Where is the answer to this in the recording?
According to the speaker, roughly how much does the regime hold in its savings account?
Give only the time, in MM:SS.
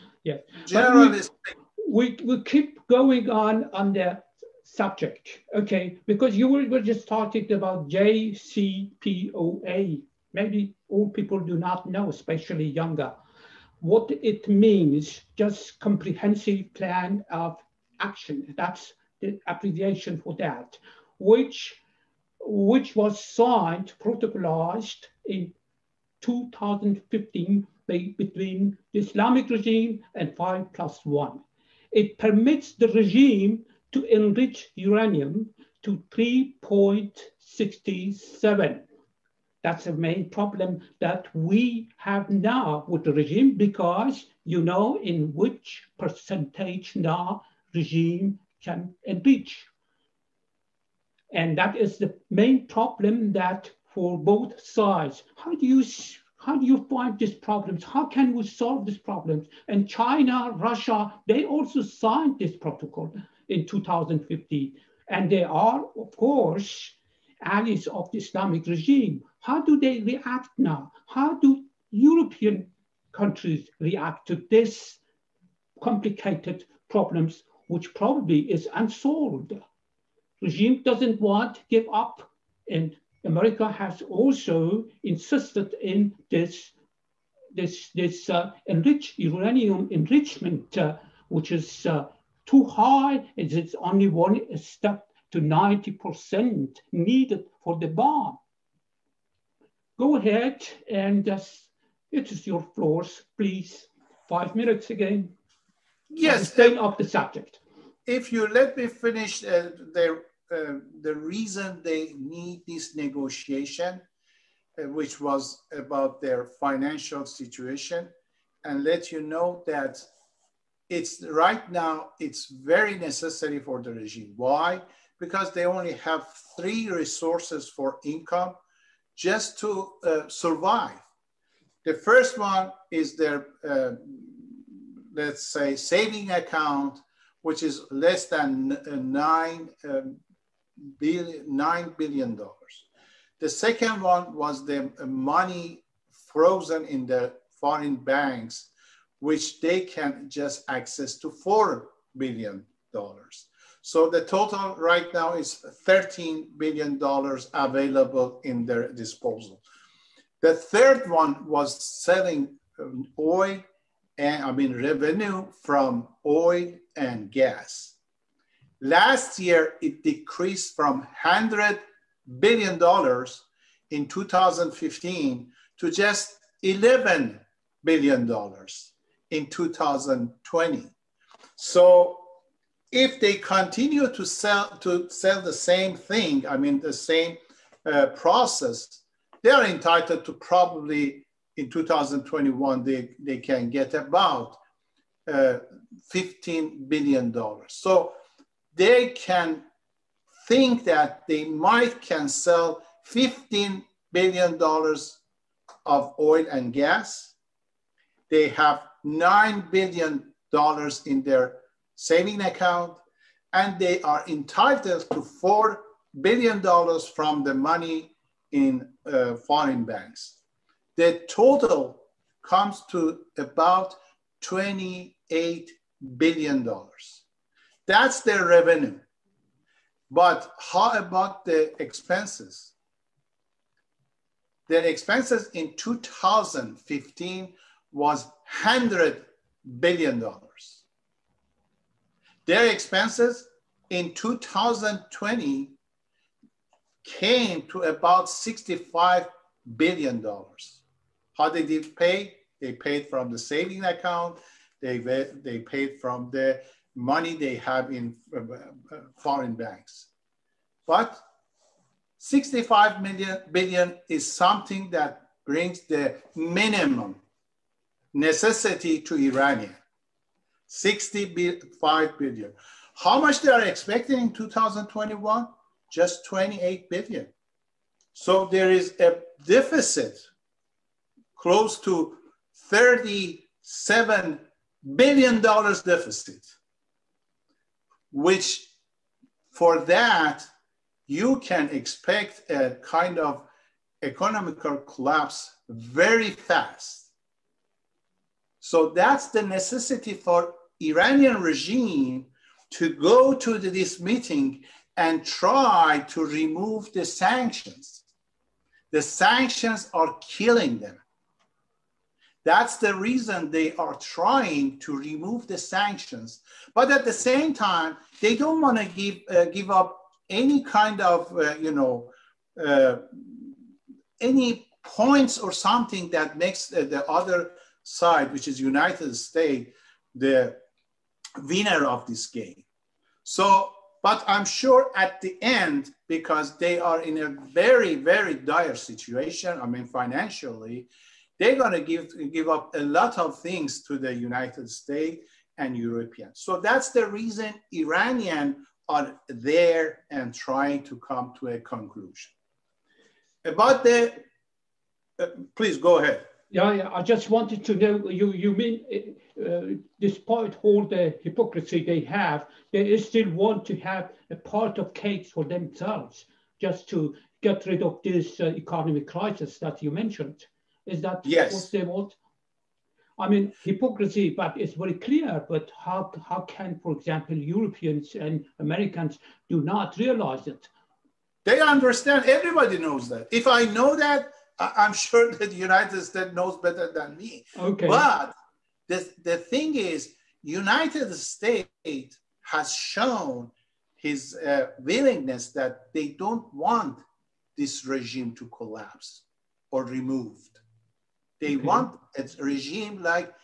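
02:21.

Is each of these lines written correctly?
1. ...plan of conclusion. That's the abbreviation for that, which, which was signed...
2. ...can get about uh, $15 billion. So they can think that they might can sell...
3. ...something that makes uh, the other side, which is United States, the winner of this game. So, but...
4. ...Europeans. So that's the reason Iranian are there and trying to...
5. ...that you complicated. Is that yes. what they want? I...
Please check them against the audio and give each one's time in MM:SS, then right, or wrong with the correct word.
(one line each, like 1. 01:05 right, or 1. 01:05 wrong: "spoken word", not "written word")
1. 00:16 wrong: "action", not "conclusion"
2. 03:13 right
3. 05:25 right
4. 05:45 right
5. 06:09 wrong: "mentioned", not "complicated".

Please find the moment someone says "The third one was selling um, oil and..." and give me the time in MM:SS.
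02:40.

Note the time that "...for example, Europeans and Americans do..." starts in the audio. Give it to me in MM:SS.
06:16.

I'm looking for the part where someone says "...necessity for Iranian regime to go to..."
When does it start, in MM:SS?
04:59.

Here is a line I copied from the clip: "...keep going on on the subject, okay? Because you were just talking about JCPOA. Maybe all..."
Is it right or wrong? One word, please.
right.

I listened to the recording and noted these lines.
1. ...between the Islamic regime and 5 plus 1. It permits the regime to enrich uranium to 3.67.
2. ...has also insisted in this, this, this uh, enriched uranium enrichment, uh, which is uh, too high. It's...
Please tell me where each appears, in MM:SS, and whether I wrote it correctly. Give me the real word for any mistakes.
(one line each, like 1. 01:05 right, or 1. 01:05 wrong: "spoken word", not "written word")
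1. 00:27 right
2. 01:23 right.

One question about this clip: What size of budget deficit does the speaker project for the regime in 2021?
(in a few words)
$37 billion.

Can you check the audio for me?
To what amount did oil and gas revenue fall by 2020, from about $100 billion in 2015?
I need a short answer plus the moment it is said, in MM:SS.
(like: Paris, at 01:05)
$11 billion, at 02:56.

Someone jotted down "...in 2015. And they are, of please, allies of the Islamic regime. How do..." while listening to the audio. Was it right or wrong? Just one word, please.
wrong.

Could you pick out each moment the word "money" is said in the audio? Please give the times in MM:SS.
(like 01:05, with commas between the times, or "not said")
02:25, 03:37, 04:16.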